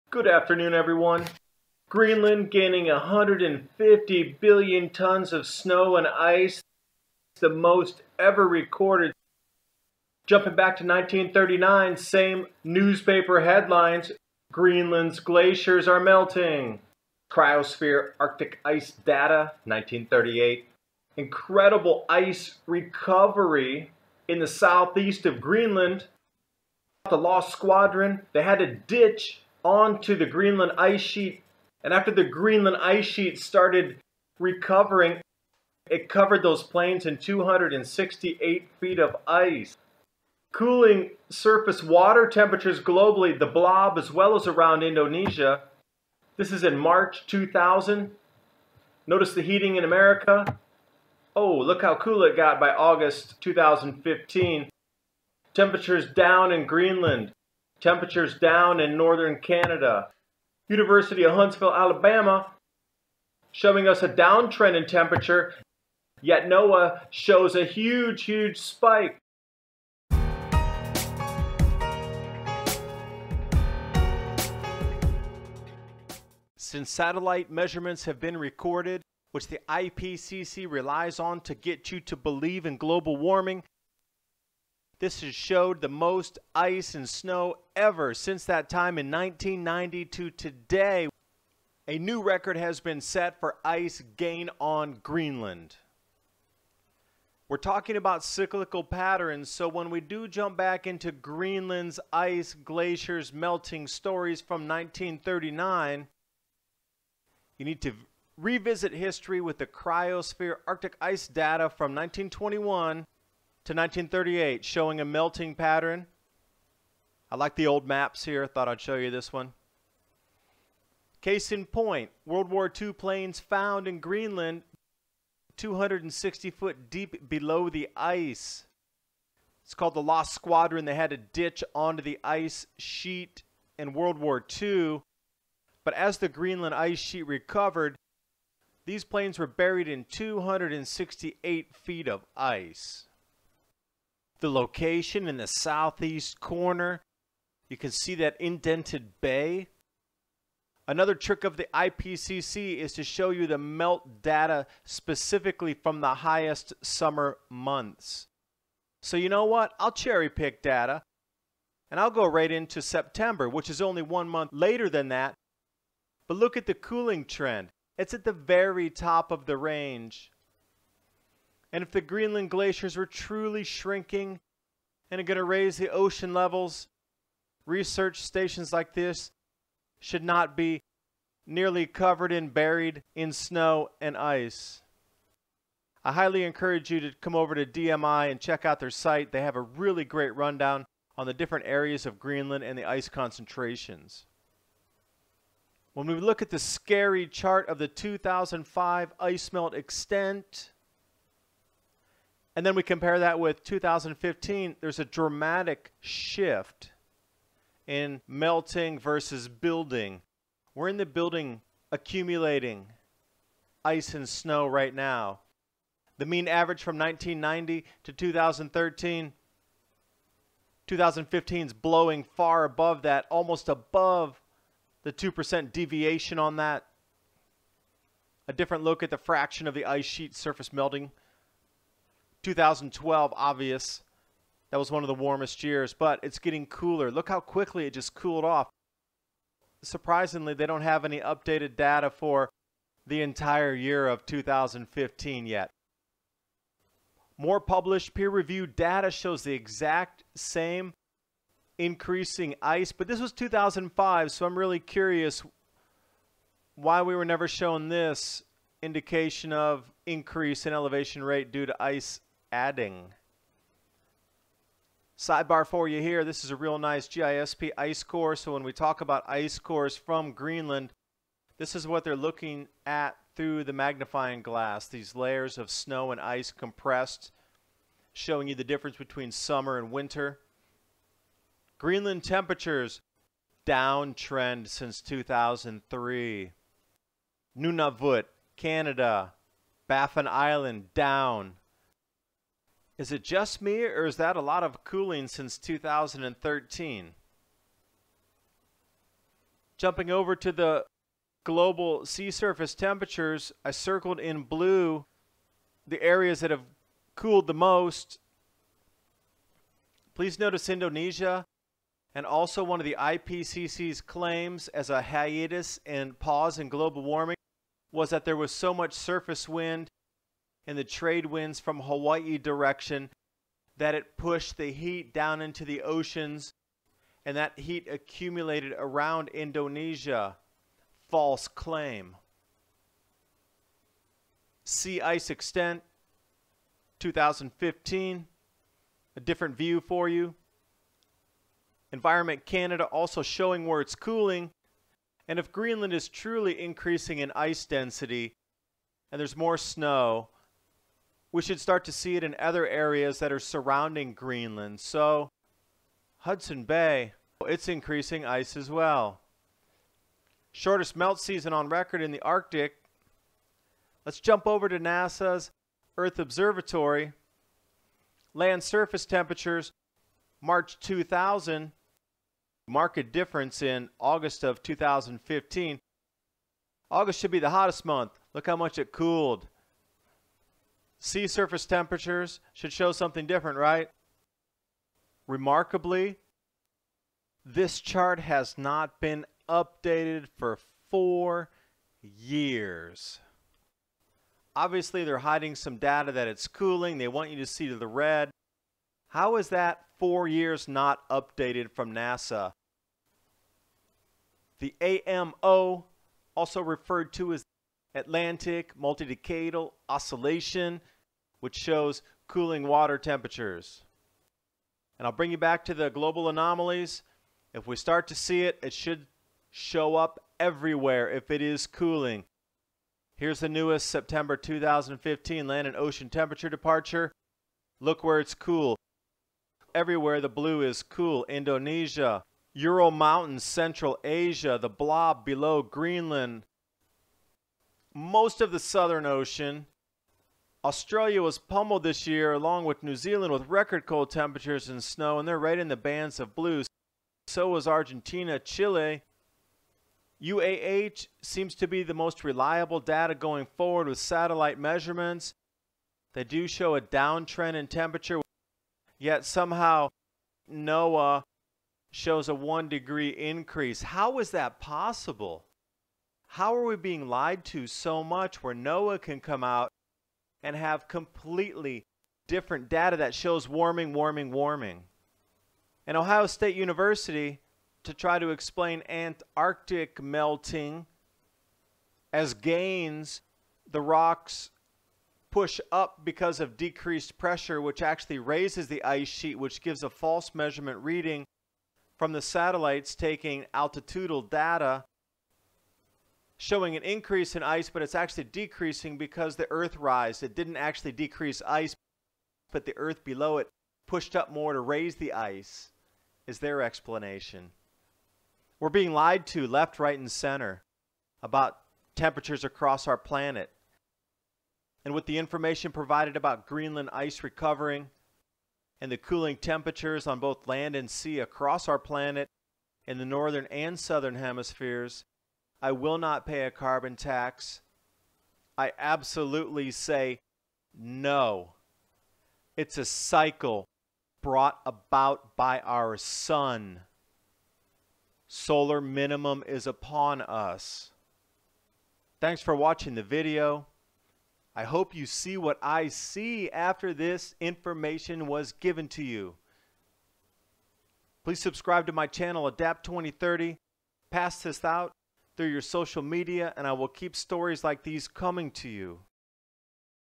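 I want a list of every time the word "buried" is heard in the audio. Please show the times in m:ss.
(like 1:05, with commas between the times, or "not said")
2:19, 3:02.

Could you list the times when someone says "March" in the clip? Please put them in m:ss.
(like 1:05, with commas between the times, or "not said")
0:46, 6:10.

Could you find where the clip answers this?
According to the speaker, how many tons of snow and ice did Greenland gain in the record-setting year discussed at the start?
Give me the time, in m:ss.
0:02.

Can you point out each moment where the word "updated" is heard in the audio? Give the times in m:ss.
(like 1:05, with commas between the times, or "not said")
4:01, 6:29, 6:41.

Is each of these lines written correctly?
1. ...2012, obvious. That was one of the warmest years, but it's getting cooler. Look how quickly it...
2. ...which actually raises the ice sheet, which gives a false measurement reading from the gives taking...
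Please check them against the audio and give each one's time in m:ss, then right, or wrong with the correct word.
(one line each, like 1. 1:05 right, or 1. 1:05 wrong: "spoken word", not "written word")
1. 3:52 right
2. 8:07 wrong: "satellites", not "gives".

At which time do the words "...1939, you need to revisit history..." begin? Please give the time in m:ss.
1:44.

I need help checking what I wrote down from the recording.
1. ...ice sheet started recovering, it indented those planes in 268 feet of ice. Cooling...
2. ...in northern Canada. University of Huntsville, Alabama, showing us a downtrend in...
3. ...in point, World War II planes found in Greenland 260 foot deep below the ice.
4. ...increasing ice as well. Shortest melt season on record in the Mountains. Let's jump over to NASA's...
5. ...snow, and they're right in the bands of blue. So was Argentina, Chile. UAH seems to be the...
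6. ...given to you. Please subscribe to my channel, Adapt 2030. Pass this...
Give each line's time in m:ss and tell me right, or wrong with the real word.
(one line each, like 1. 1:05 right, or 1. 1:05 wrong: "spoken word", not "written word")
1. 0:32 wrong: "covered", not "indented"
2. 0:58 right
3. 2:01 right
4. 5:57 wrong: "Arctic", not "Mountains"
5. 7:24 right
6. 9:08 right.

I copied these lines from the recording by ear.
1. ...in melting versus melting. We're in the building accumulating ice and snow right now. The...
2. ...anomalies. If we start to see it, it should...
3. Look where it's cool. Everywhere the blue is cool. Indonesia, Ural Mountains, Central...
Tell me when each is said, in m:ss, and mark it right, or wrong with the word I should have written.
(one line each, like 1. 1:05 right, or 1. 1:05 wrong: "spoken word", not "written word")
1. 3:27 wrong: "building", not "melting"
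2. 6:56 right
3. 7:07 right.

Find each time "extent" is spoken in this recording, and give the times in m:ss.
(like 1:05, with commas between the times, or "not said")
3:19, 5:35.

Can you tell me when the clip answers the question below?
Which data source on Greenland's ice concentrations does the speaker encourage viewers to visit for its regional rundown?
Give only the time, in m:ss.
3:07.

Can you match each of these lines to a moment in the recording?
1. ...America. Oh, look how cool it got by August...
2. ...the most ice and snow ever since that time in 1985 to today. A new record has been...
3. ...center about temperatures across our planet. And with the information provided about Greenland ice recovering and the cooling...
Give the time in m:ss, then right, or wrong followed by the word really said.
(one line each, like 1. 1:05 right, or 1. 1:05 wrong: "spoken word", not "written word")
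1. 0:49 right
2. 1:25 wrong: "1990", not "1985"
3. 8:30 right.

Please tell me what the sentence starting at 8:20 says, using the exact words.
It didn't actually decrease ice, but the Earth below it pushed up more to raise the ice, is their explanation.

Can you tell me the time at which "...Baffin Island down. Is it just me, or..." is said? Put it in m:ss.
4:49.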